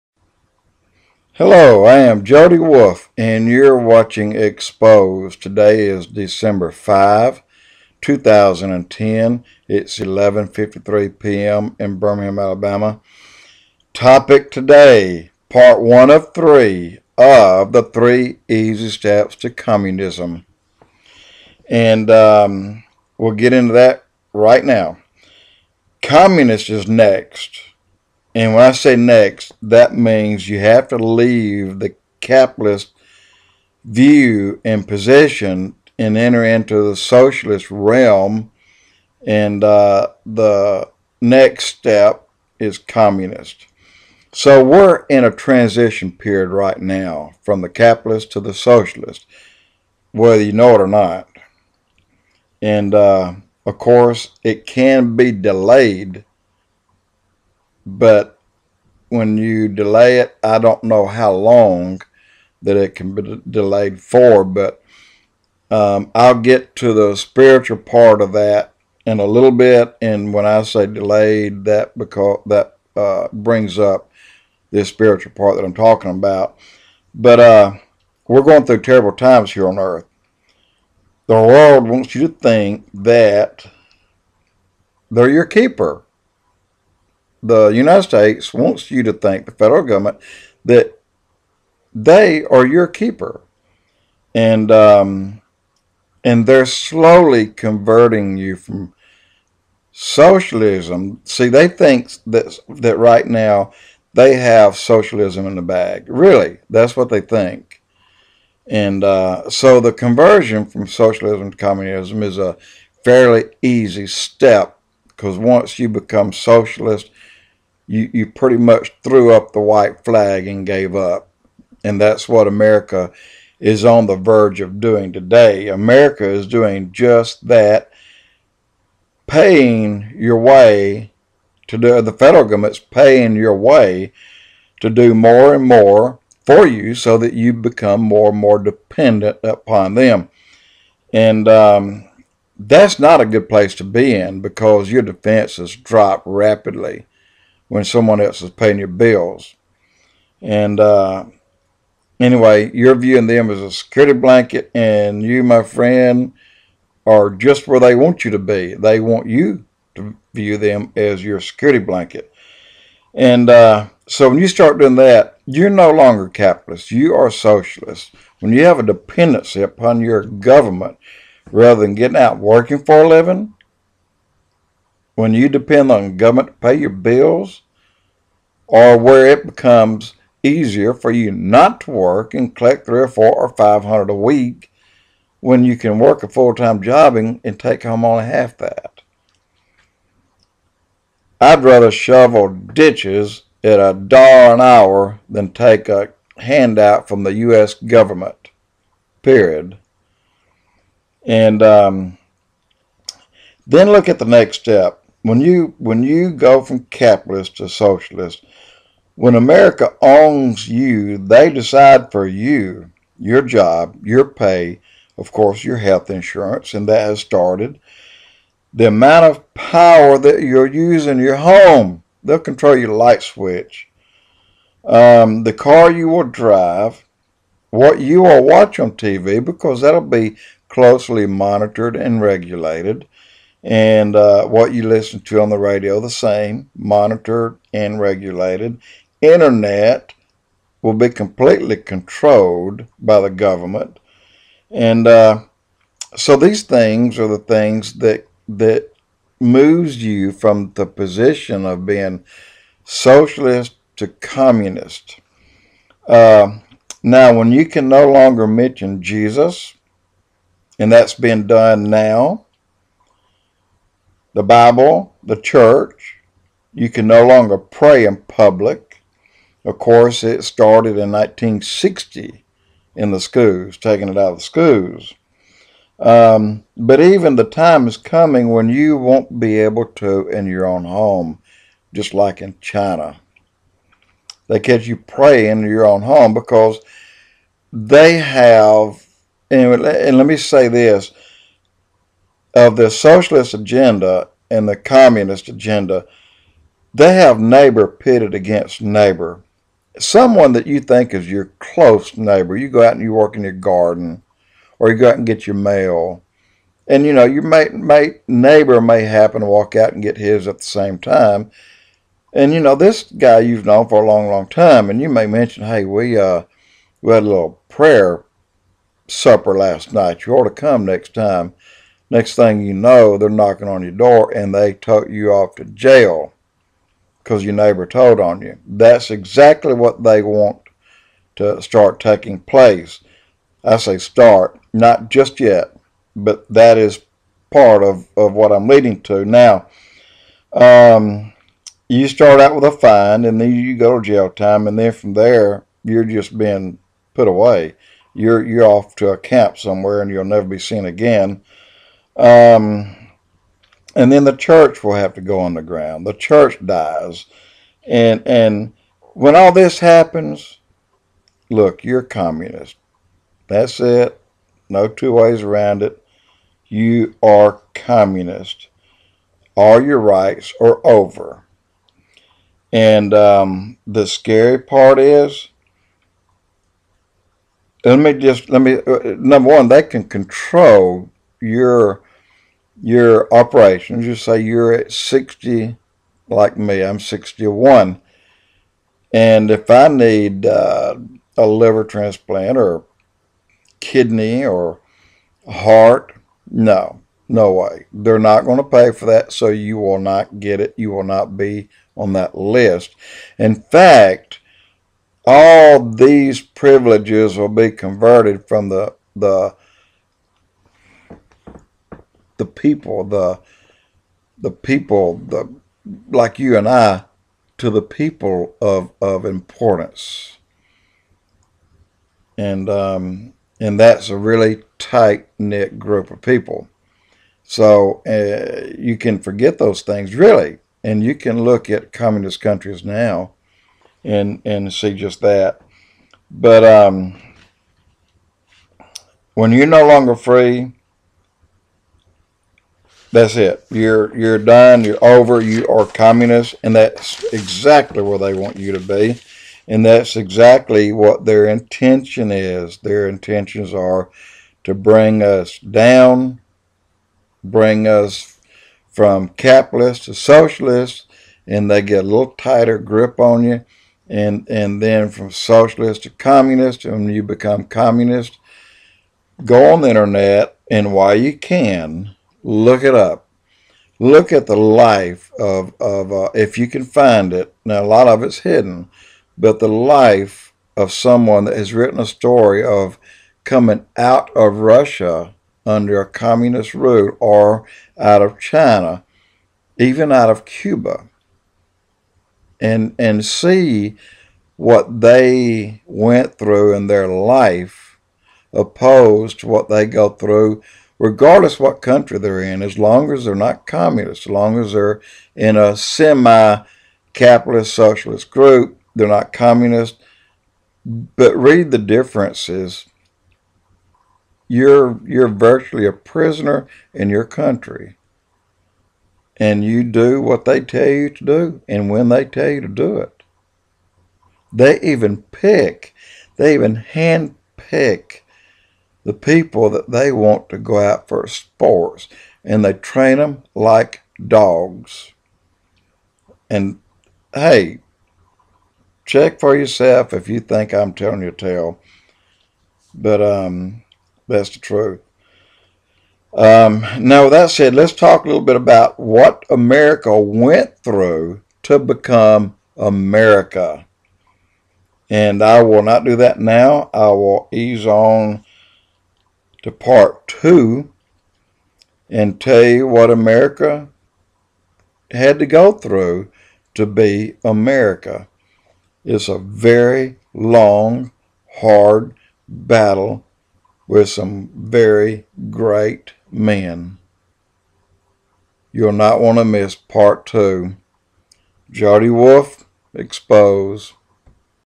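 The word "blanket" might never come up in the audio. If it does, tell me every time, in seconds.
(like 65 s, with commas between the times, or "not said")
154 s, 161 s.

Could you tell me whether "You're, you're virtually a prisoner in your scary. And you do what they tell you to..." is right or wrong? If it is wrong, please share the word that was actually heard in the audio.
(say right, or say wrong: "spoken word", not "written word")
wrong: "country", not "scary".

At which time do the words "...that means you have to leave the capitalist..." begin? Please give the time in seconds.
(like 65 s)
29 s.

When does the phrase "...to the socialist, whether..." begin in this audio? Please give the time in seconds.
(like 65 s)
48 s.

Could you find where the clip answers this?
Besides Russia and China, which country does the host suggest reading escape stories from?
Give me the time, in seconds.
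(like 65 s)
490 s.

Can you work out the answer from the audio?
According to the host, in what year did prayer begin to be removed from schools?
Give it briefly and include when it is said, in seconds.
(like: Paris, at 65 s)
1960, at 271 s.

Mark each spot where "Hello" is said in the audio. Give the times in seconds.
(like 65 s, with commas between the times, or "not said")
1 s.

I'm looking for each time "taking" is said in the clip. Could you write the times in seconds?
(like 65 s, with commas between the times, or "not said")
273 s, 332 s.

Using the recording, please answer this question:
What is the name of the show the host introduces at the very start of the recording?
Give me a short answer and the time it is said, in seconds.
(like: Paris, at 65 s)
Exposed, at 4 s.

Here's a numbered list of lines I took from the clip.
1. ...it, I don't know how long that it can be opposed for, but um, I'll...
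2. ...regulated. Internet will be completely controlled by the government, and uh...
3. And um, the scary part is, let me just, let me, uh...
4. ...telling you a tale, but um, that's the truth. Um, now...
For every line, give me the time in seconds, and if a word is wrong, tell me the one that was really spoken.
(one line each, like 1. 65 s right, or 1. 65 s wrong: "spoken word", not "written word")
1. 60 s wrong: "delayed", not "opposed"
2. 237 s right
3. 372 s right
4. 540 s right.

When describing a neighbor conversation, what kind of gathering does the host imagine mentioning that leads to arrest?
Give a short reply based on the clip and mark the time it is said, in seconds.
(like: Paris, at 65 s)
prayer supper, at 317 s.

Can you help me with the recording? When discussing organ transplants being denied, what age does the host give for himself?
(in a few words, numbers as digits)
61.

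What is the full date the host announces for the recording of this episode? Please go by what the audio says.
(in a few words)
December 5, 2010.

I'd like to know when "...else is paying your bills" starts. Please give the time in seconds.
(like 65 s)
148 s.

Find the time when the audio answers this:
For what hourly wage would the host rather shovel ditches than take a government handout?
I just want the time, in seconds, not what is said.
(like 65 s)
193 s.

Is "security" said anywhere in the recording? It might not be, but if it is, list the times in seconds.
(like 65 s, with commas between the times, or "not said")
153 s, 161 s.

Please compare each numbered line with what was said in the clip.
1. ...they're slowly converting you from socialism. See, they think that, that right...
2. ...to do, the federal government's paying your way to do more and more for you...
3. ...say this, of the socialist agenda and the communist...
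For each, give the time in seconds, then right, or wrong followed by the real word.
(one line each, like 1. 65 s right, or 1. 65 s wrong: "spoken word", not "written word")
1. 96 s right
2. 131 s right
3. 290 s right.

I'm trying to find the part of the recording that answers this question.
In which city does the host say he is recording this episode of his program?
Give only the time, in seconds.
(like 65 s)
11 s.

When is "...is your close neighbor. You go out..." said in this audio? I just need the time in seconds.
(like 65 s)
301 s.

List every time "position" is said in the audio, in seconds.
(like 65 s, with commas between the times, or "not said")
34 s, 250 s.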